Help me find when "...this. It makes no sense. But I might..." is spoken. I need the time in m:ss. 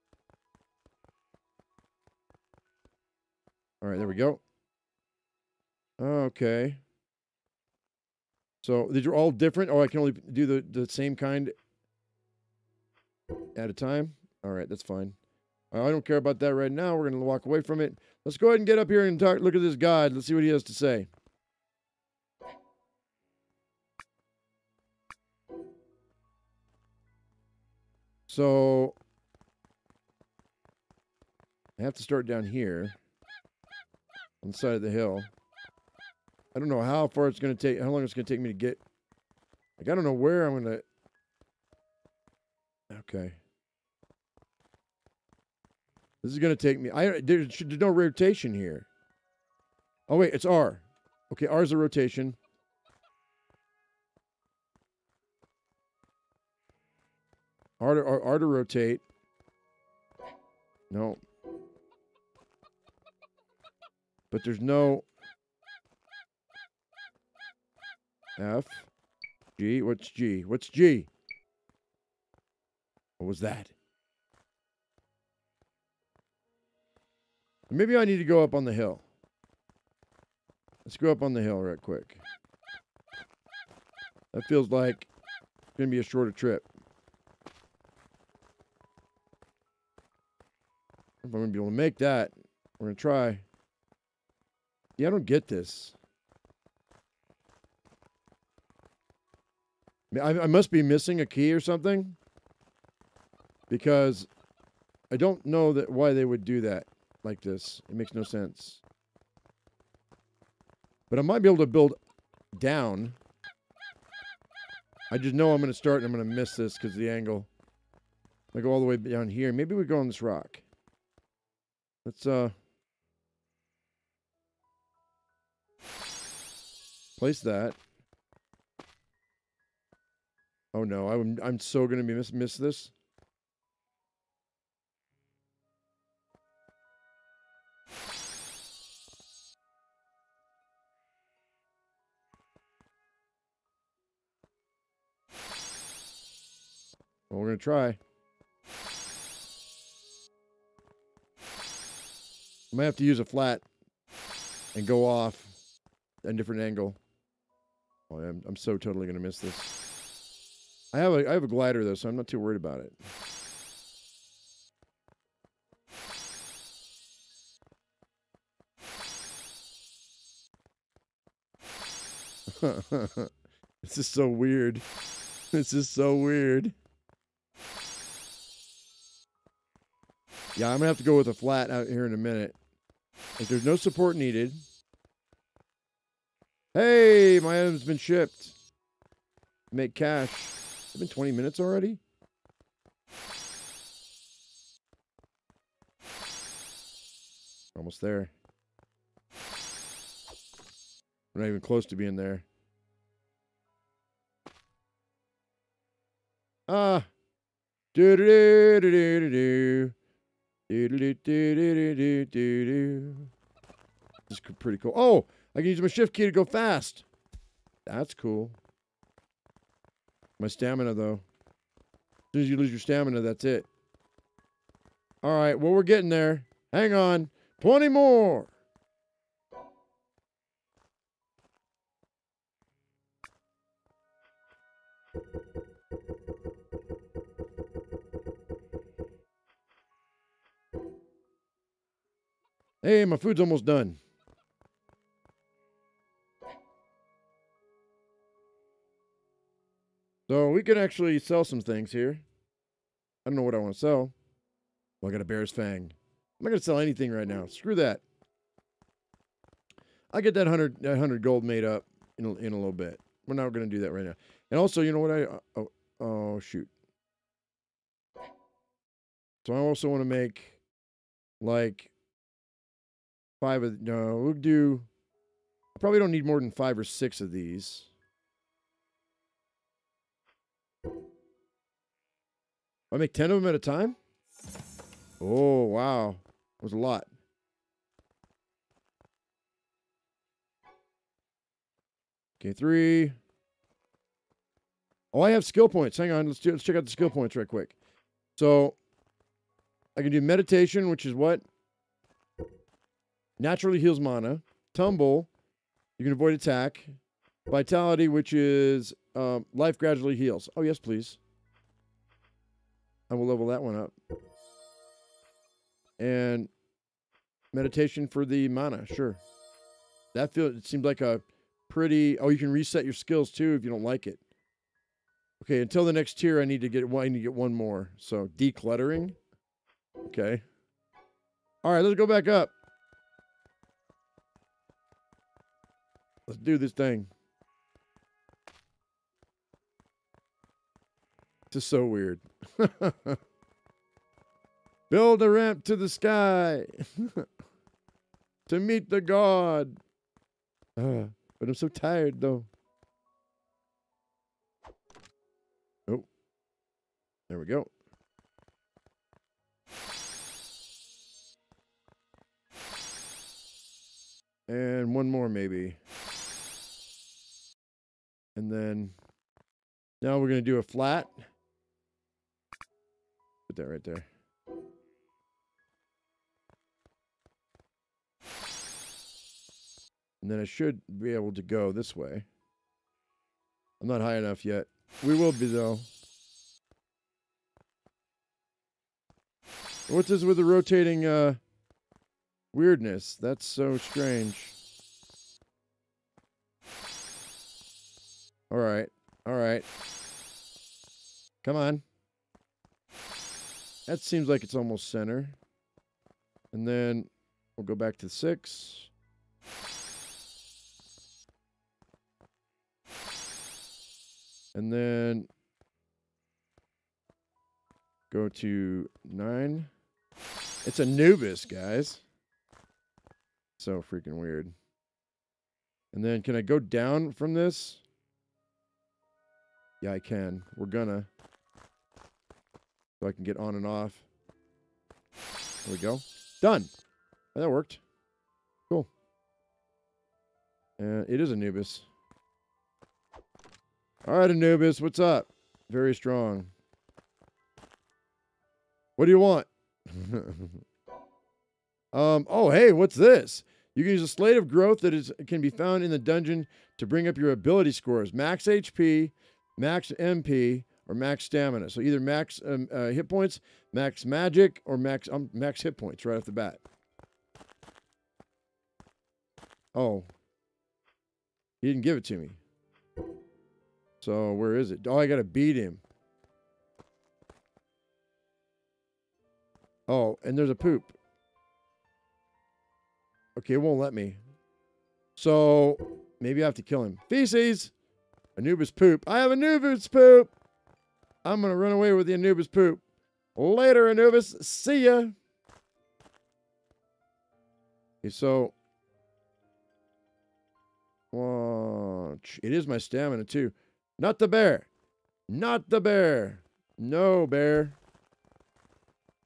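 1:47.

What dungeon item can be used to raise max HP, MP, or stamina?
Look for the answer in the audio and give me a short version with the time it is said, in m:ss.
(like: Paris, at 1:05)
Slate of growth, at 7:34.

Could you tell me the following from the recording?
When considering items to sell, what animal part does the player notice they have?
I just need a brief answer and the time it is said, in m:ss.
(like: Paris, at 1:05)
Bear's fang, at 4:15.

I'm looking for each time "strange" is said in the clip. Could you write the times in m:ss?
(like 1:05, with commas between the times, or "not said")
6:33.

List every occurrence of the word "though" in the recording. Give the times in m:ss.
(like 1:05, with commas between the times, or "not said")
2:41, 3:40, 5:52, 6:25.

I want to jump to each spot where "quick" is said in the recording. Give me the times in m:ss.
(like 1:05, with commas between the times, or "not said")
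1:21, 4:57.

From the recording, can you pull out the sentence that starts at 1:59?
Maybe we go on this rock.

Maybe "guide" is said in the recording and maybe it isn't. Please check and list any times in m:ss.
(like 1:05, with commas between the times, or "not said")
0:19.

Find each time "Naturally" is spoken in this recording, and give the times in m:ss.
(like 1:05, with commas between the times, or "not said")
5:03.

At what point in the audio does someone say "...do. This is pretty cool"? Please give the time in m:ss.
3:32.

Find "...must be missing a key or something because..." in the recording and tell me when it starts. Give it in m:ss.
1:40.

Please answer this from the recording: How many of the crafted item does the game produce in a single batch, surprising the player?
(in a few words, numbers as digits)
10.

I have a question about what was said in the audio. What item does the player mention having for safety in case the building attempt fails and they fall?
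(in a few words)
A glider.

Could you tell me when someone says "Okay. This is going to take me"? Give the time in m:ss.
0:42.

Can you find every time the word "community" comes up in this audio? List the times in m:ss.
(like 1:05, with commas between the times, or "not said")
not said.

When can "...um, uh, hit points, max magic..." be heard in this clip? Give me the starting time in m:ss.
7:42.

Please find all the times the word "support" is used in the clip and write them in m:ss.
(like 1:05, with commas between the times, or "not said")
3:03.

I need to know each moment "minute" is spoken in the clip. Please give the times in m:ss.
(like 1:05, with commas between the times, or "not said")
3:02, 3:11.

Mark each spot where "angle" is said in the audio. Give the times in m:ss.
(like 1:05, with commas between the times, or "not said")
1:57, 2:36.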